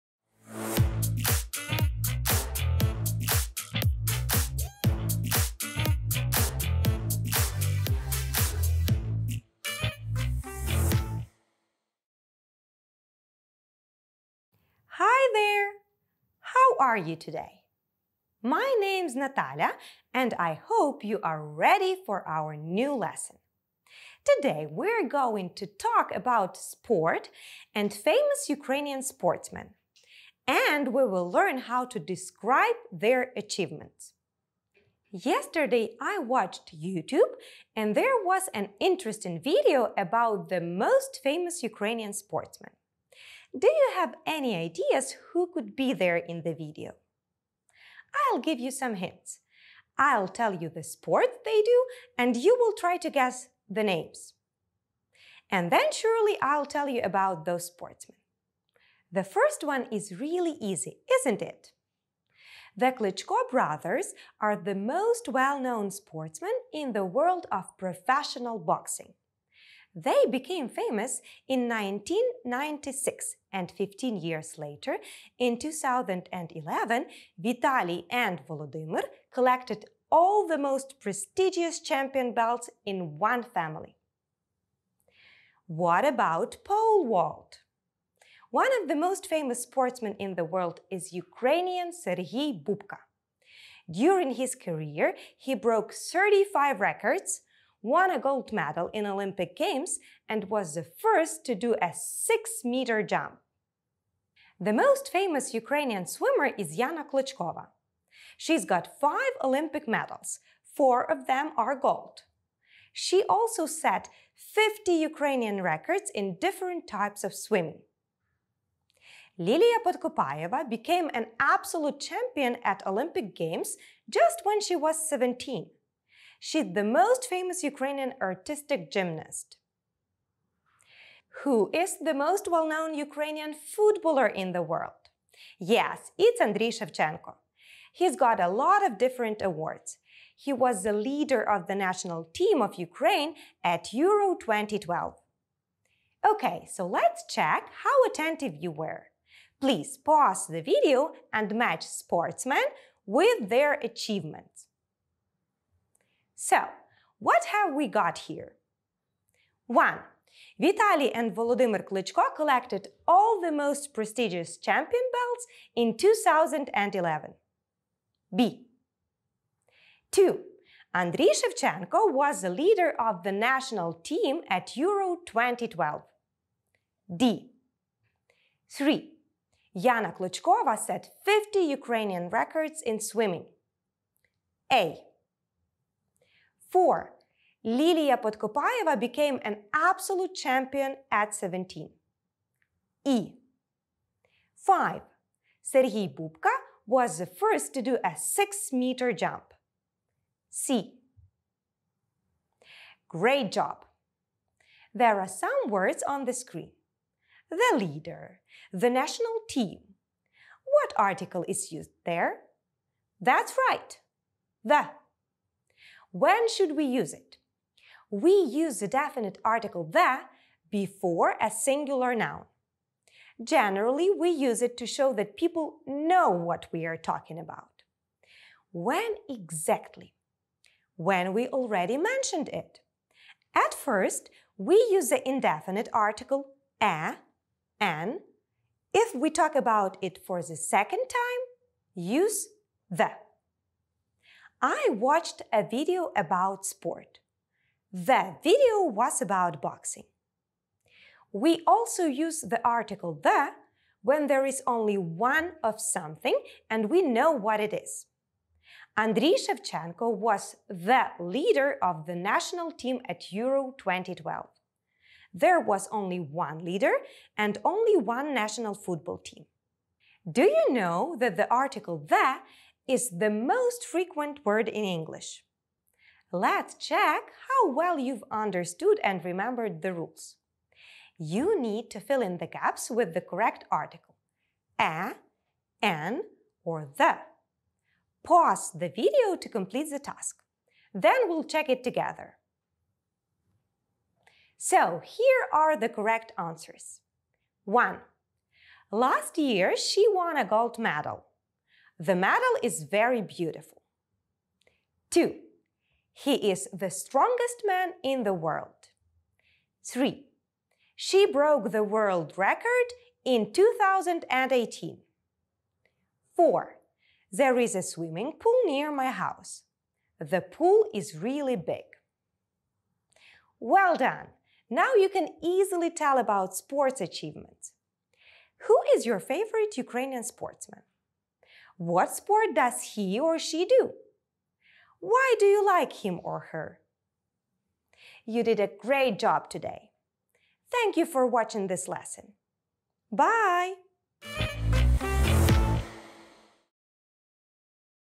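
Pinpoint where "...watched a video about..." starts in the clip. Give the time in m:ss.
4:04.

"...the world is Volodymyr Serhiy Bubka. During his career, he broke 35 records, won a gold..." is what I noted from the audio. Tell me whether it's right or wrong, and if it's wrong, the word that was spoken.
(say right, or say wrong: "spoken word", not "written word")
wrong: "Ukrainian", not "Volodymyr".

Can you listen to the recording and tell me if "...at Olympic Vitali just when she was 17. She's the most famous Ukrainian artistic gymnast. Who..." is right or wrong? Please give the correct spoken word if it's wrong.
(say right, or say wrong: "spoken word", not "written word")
wrong: "Games", not "Vitali".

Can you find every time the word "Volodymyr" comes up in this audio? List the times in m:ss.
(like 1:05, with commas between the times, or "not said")
1:18, 2:41.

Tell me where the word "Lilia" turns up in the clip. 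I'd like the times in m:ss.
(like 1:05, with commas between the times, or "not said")
1:59, 3:07.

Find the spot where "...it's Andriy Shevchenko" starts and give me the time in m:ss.
2:16.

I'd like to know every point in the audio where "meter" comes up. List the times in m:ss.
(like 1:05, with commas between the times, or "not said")
1:42, 3:18.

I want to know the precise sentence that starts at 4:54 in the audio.
So here are the correct answers.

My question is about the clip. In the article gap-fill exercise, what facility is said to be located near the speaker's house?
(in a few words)
swimming pool.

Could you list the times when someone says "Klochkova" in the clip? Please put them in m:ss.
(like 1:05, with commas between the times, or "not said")
1:47, 3:00.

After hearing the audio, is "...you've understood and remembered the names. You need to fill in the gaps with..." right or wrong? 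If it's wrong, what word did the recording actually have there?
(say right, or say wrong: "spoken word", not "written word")
wrong: "rules", not "names".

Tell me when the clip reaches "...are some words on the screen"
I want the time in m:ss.
3:25.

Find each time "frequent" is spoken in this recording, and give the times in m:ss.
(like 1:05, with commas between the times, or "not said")
4:33.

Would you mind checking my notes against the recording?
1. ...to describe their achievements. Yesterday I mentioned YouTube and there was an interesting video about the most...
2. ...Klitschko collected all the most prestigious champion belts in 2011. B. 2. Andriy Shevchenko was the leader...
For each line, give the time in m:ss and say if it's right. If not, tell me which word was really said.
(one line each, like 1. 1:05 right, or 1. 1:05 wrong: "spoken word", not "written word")
1. 0:31 wrong: "watched", not "mentioned"
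2. 2:41 right.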